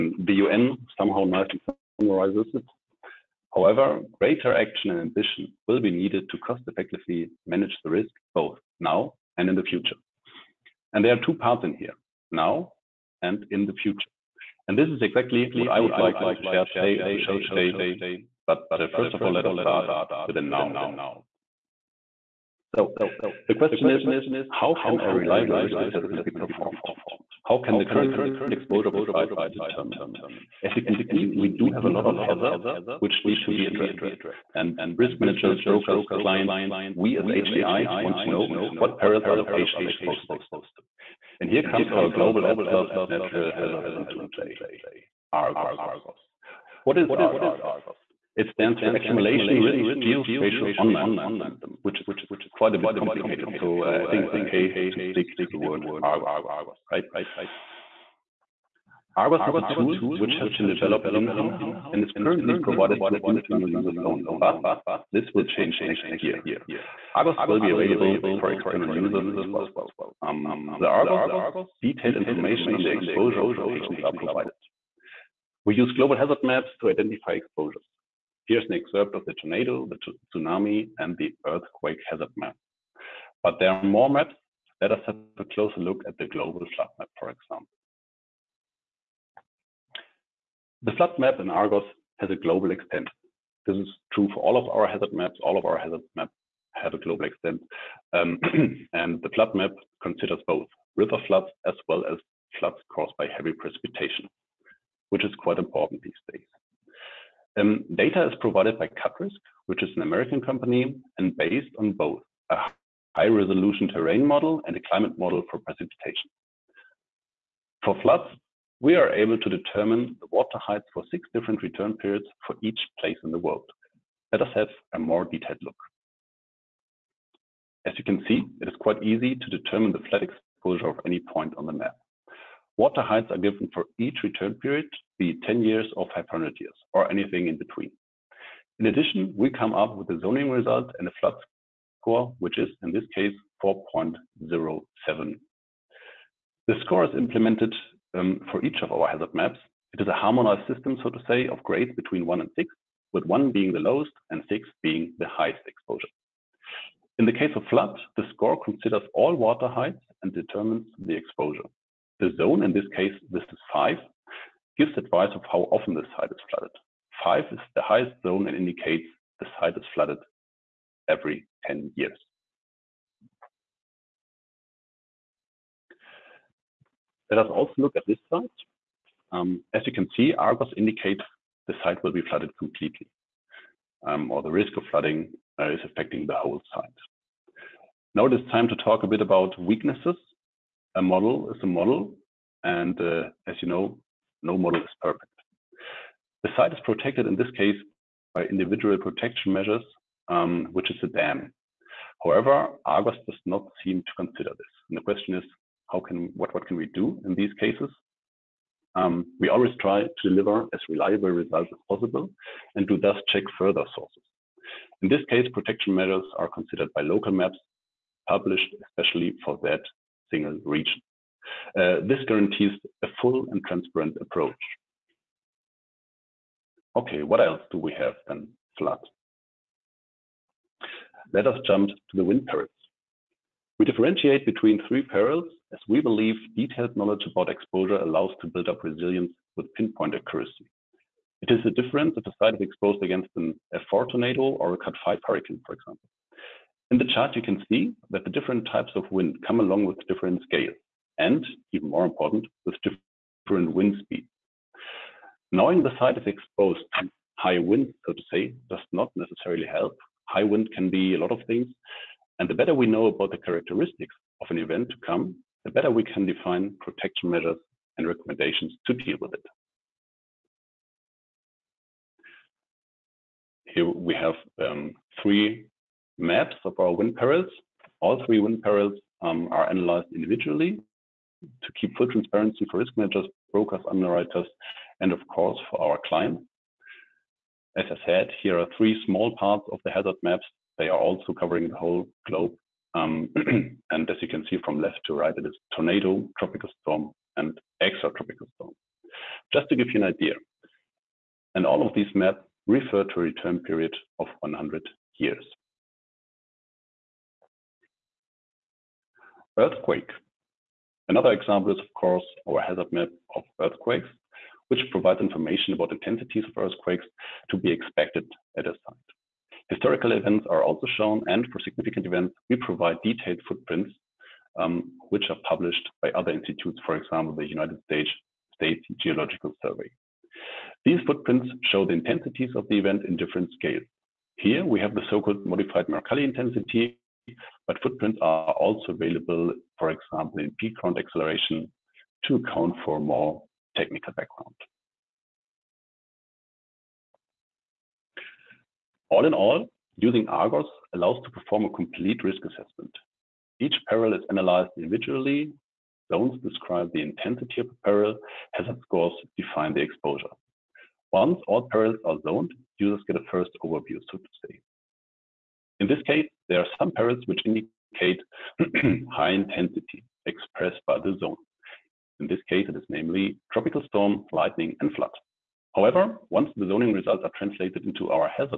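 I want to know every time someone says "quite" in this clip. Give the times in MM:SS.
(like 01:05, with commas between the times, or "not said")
00:52, 01:45, 02:08.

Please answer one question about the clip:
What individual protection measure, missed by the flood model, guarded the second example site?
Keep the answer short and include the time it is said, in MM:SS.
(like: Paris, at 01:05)
A dam, at 03:21.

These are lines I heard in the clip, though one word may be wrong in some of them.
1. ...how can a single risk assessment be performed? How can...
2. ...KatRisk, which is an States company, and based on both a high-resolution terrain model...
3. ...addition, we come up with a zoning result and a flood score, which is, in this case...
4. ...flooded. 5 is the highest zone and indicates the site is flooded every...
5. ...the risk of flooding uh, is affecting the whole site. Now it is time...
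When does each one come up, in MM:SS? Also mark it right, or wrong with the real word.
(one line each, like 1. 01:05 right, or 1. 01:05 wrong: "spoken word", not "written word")
1. 00:24 wrong: "reliable", not "single"
2. 01:48 wrong: "American", not "States"
3. 02:18 right
4. 02:46 right
5. 03:04 right.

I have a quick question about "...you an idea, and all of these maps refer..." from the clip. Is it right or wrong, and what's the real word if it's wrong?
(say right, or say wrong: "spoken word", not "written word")
right.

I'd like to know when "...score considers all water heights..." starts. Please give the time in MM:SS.
02:38.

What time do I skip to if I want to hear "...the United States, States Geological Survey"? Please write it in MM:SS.
05:27.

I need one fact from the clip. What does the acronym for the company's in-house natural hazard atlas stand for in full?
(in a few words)
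Accumulation Risk Geospatial Online System.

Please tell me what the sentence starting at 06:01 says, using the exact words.
Once all perils are zoned, users get a first overview, so to say.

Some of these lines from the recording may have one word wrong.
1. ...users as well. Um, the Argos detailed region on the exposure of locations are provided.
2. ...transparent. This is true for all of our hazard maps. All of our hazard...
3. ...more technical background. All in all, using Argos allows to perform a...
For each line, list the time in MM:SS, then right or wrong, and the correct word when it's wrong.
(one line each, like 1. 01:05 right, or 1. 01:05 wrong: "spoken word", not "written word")
1. 01:08 wrong: "information", not "region"
2. 01:32 wrong: "extent", not "transparent"
3. 05:42 right.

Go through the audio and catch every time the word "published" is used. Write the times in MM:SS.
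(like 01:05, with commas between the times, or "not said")
03:38, 05:25.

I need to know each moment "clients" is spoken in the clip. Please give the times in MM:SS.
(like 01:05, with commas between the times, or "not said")
00:36, 04:46.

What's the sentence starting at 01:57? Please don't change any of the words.
For floods, we are able to determine the water heights for six different return periods for each place in the world.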